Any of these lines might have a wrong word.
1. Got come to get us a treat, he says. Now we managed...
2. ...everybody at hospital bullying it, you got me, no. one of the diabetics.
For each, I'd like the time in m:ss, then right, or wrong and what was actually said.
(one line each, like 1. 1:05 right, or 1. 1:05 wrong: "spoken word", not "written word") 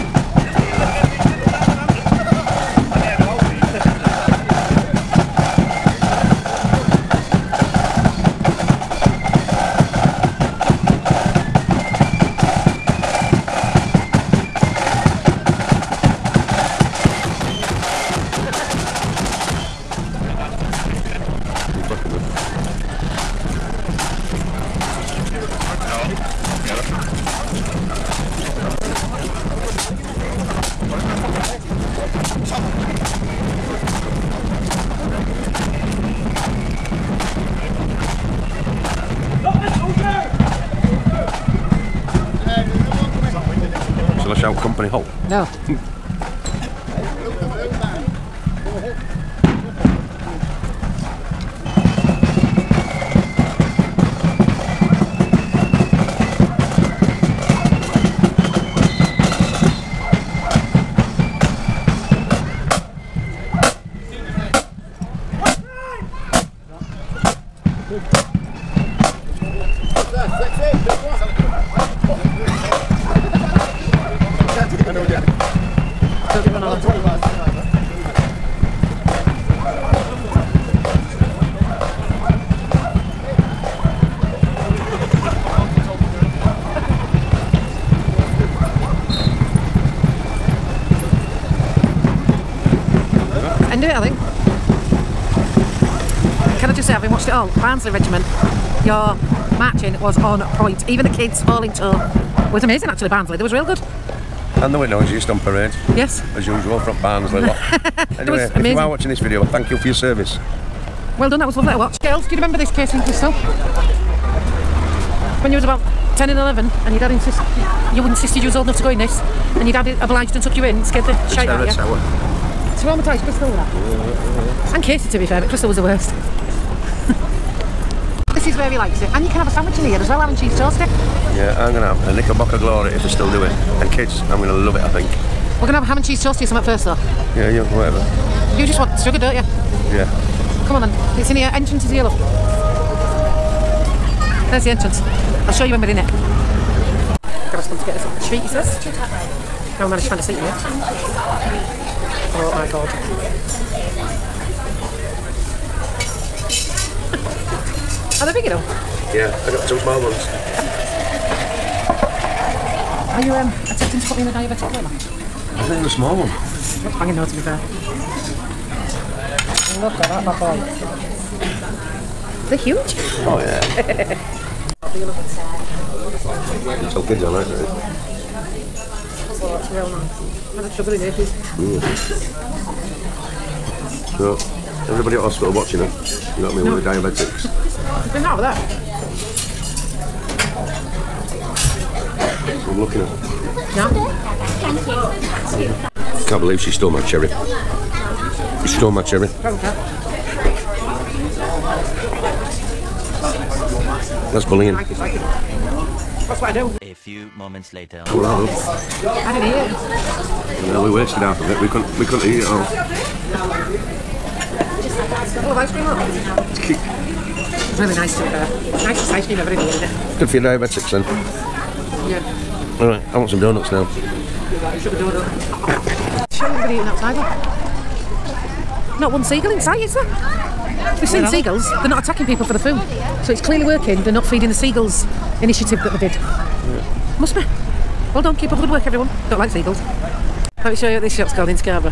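1. 2:27 right
2. 3:04 wrong: "watching", not "bullying".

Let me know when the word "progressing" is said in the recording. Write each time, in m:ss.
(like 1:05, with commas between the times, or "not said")
not said.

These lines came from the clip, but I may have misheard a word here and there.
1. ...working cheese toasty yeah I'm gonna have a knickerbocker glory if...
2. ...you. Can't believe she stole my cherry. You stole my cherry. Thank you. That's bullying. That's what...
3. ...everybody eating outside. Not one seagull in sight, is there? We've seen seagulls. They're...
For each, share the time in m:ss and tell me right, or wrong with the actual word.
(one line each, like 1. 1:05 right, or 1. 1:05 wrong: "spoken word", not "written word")
1. 2:10 wrong: "having", not "working"
2. 3:16 right
3. 3:46 right.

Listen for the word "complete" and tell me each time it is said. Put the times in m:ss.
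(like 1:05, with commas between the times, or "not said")
not said.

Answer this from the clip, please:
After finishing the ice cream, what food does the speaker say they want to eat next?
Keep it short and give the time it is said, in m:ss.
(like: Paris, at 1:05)
donuts, at 3:43.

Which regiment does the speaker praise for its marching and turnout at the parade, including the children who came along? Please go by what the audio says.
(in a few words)
Barnsley Regiment.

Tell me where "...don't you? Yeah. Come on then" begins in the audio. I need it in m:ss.
2:19.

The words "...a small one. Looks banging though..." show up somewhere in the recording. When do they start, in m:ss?
2:45.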